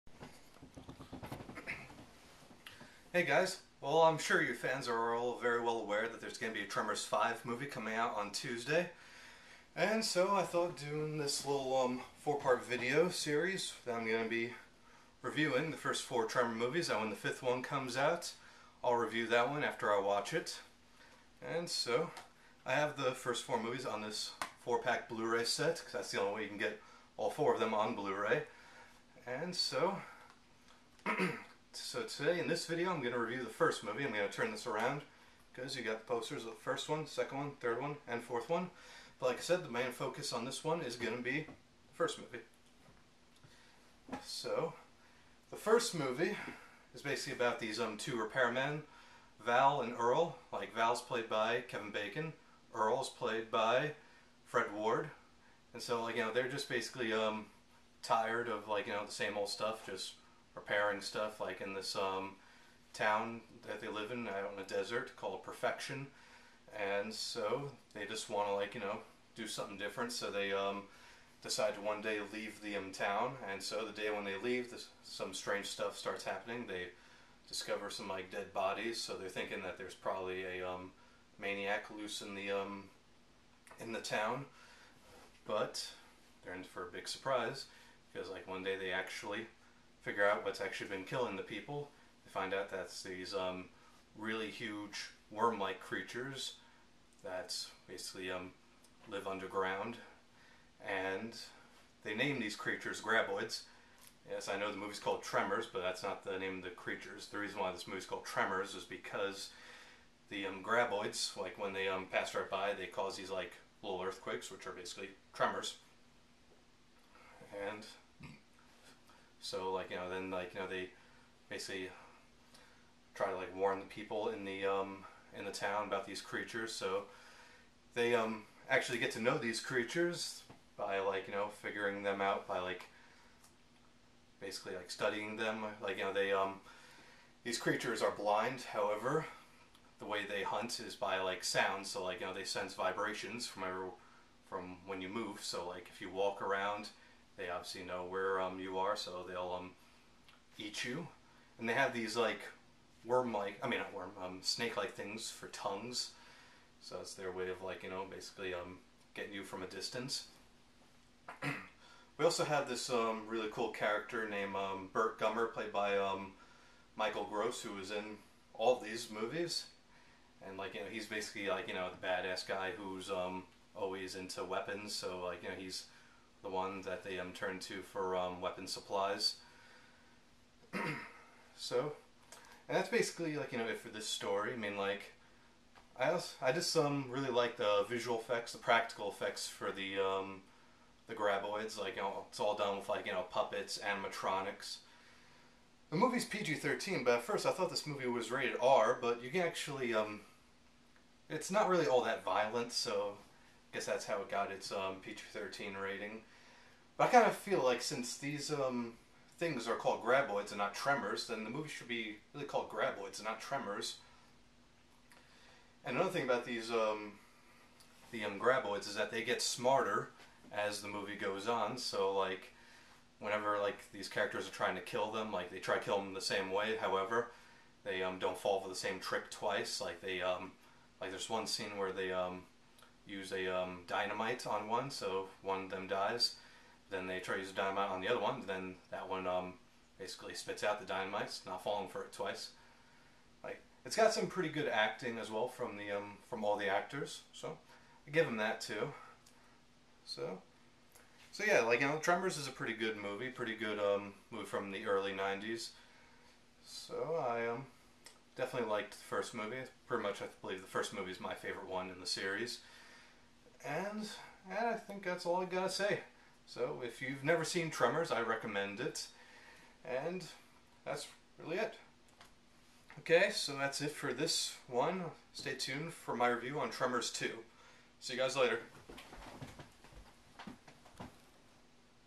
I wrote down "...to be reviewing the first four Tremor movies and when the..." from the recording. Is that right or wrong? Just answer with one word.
right.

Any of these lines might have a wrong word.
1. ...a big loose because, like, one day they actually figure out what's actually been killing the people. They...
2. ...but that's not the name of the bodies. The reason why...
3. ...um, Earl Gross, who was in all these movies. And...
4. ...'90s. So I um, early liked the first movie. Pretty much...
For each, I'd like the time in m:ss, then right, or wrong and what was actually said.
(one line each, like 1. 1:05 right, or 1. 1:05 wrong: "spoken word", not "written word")
1. 1:26 wrong: "surprise", not "loose"
2. 1:45 wrong: "creatures", not "bodies"
3. 2:45 wrong: "Michael", not "Earl"
4. 4:15 wrong: "definitely", not "early".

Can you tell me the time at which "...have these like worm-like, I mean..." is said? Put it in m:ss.
2:31.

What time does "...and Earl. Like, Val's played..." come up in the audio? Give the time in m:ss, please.
0:49.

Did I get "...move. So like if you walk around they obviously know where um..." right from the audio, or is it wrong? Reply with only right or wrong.
right.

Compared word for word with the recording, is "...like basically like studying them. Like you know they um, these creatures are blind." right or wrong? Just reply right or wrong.
right.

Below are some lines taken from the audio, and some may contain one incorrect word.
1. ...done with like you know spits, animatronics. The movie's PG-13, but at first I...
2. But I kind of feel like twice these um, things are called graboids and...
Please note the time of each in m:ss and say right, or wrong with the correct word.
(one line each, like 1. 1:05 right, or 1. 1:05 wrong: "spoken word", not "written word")
1. 3:12 wrong: "puppets", not "spits"
2. 3:26 wrong: "since", not "twice".